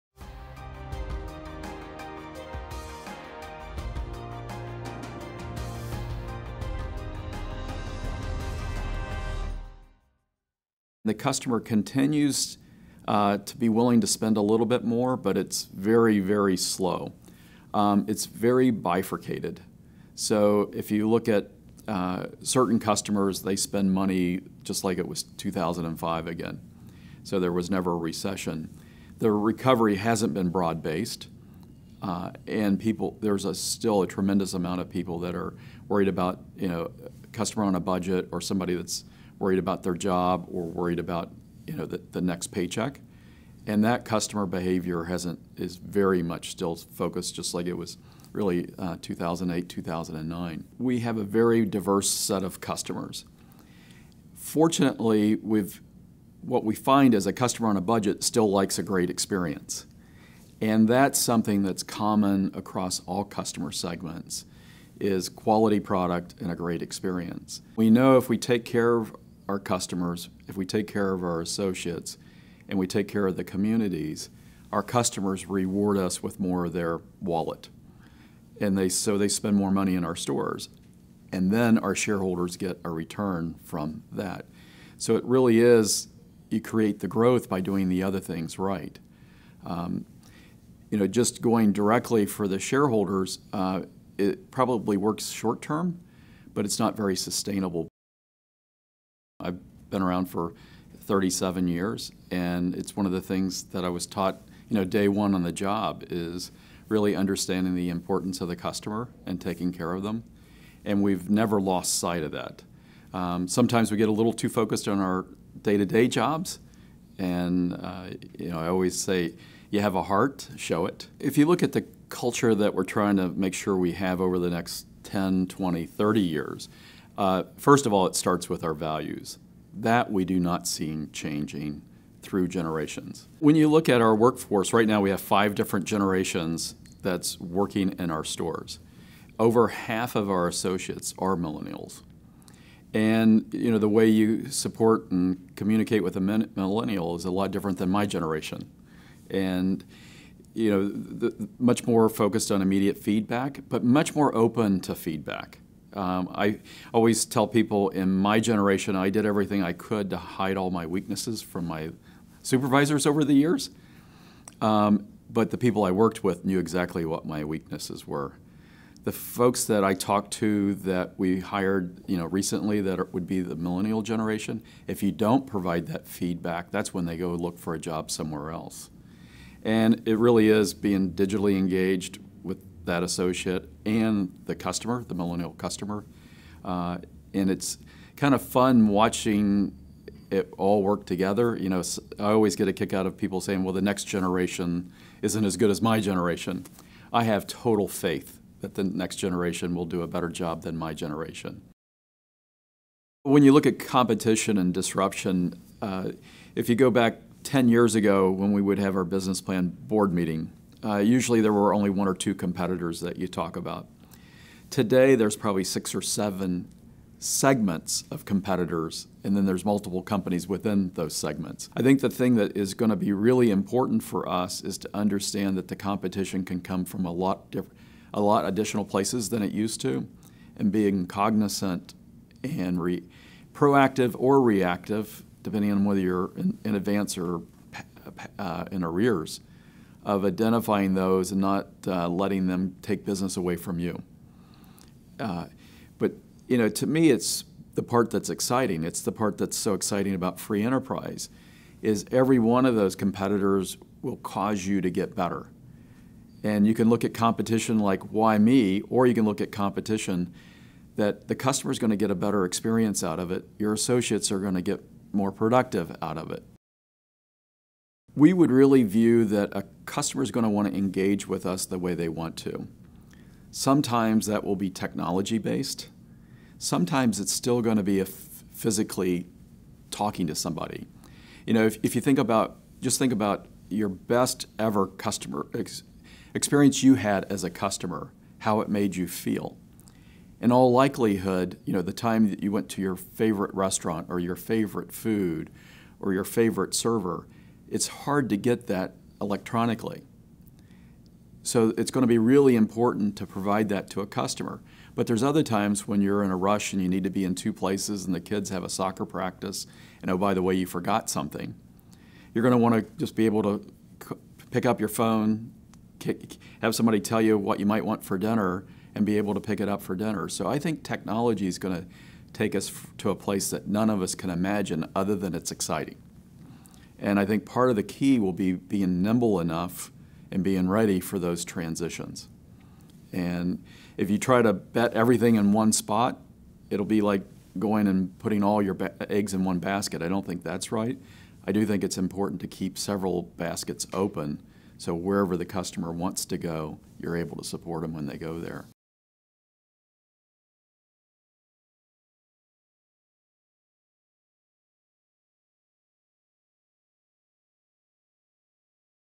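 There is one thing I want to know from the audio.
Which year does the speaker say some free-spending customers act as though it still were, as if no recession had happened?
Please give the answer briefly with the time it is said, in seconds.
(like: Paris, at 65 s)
2005, at 25 s.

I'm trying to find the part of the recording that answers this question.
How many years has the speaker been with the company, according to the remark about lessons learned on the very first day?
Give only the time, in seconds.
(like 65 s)
101 s.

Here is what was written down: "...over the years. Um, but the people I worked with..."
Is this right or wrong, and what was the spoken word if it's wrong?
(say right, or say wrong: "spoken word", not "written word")
right.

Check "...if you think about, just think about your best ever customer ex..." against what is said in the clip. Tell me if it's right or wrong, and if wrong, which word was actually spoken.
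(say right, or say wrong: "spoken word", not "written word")
right.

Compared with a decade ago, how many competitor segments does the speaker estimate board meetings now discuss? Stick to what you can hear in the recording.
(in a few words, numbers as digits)
6 or 7.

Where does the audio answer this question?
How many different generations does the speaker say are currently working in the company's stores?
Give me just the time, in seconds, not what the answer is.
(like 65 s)
135 s.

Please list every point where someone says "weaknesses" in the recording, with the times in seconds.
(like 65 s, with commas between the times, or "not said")
160 s, 167 s.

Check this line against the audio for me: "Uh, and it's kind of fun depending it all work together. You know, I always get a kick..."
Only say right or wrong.
wrong.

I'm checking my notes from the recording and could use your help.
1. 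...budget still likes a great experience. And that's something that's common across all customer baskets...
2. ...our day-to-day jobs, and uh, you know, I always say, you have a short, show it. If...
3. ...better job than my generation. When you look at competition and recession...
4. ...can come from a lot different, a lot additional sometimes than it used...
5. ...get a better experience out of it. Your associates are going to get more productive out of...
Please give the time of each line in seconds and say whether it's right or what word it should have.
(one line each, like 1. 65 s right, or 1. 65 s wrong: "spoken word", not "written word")
1. 57 s wrong: "segments", not "baskets"
2. 114 s wrong: "heart", not "short"
3. 200 s wrong: "disruption", not "recession"
4. 226 s wrong: "places", not "sometimes"
5. 261 s right.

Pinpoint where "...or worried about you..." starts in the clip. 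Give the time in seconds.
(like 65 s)
40 s.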